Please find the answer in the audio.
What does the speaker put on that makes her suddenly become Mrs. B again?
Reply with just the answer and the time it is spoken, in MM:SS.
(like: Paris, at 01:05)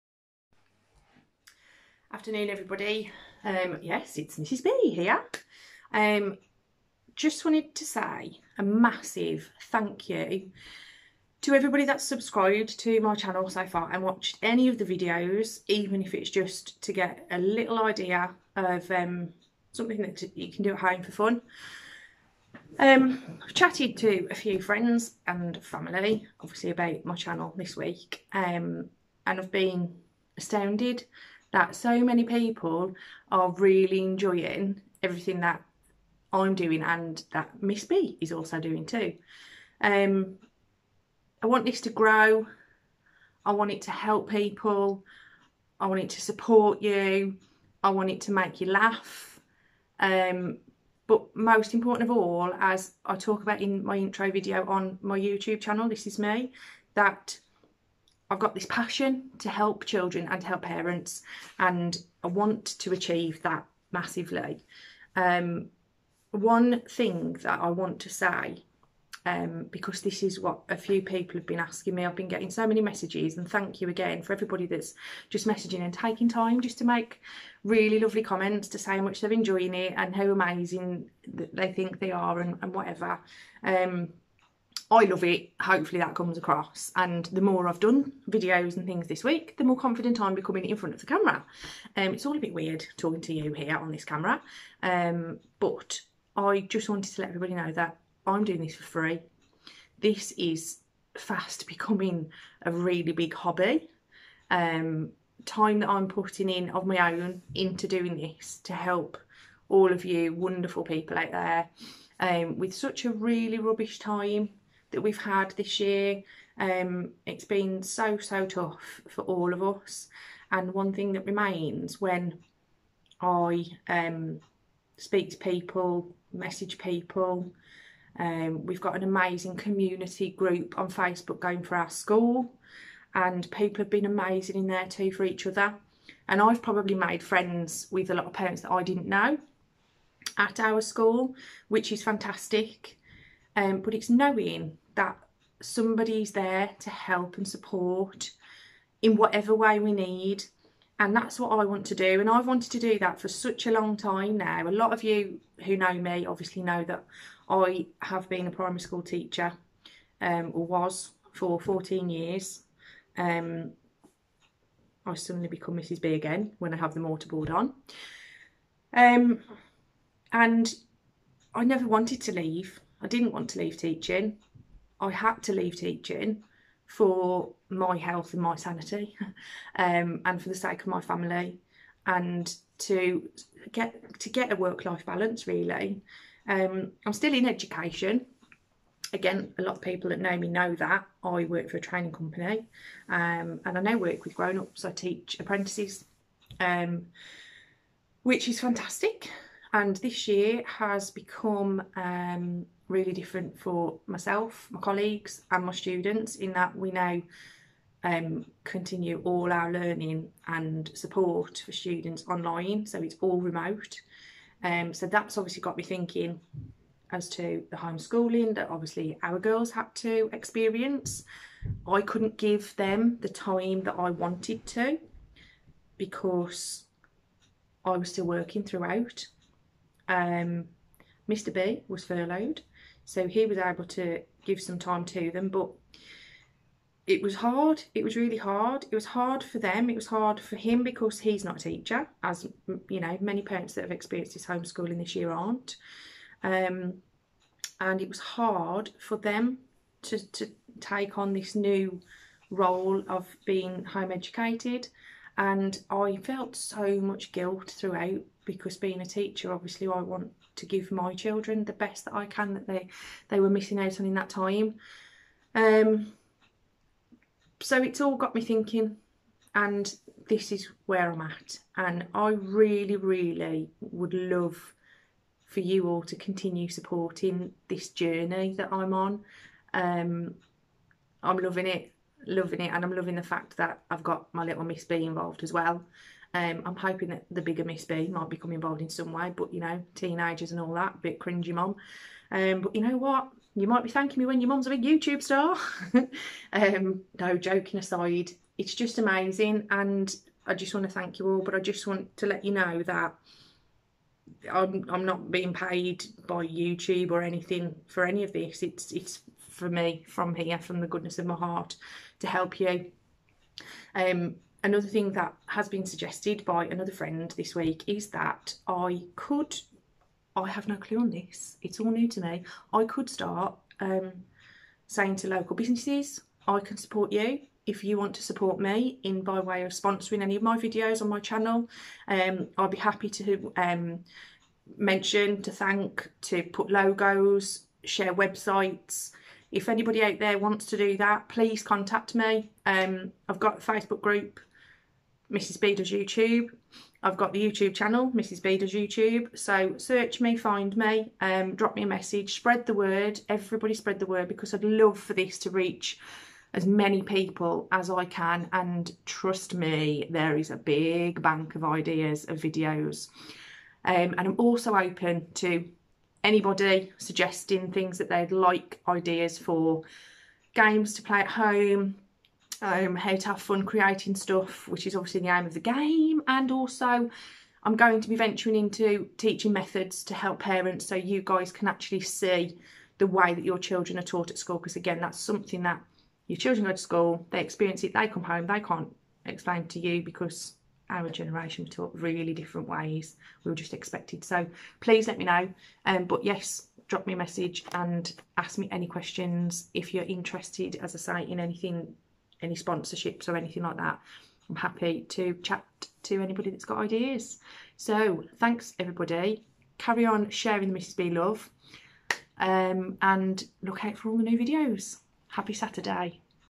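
Mortarboard, at 02:46.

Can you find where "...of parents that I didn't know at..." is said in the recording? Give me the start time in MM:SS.
02:18.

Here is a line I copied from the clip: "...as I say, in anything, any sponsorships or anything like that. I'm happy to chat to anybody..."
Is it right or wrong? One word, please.
right.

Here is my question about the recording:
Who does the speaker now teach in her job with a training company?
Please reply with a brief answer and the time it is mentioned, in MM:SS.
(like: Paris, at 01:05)
Apprentices, at 03:15.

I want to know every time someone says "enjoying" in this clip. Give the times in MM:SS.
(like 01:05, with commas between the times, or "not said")
00:34, 01:19.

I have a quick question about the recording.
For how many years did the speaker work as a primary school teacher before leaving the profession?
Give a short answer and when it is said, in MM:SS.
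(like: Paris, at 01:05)
14, at 02:41.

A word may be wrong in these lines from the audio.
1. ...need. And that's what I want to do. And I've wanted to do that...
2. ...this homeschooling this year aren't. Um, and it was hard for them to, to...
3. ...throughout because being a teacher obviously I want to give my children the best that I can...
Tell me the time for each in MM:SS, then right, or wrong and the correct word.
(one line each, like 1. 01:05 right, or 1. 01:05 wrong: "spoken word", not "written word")
1. 02:29 right
2. 04:04 right
3. 04:17 right.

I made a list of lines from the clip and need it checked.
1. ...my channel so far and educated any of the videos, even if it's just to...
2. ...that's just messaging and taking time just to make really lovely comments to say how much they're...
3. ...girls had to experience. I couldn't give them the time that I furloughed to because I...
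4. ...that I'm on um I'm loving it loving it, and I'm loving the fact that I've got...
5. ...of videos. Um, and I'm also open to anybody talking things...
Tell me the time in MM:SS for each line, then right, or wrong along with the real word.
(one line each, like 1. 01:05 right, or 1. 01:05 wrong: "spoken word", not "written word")
1. 00:12 wrong: "watched", not "educated"
2. 01:14 right
3. 03:39 wrong: "wanted", not "furloughed"
4. 04:38 right
5. 06:02 wrong: "suggesting", not "talking".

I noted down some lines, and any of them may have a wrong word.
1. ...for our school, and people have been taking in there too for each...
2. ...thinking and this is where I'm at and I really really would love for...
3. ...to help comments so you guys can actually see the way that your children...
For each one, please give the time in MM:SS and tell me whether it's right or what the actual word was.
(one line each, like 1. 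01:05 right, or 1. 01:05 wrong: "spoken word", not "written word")
1. 02:11 wrong: "amazing", not "taking"
2. 04:28 right
3. 06:20 wrong: "parents", not "comments".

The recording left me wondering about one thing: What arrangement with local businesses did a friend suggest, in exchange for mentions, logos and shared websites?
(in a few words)
Sponsoring.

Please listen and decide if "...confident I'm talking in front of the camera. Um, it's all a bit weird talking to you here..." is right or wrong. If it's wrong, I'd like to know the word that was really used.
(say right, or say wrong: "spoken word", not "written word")
wrong: "becoming", not "talking".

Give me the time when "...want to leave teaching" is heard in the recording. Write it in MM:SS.
02:53.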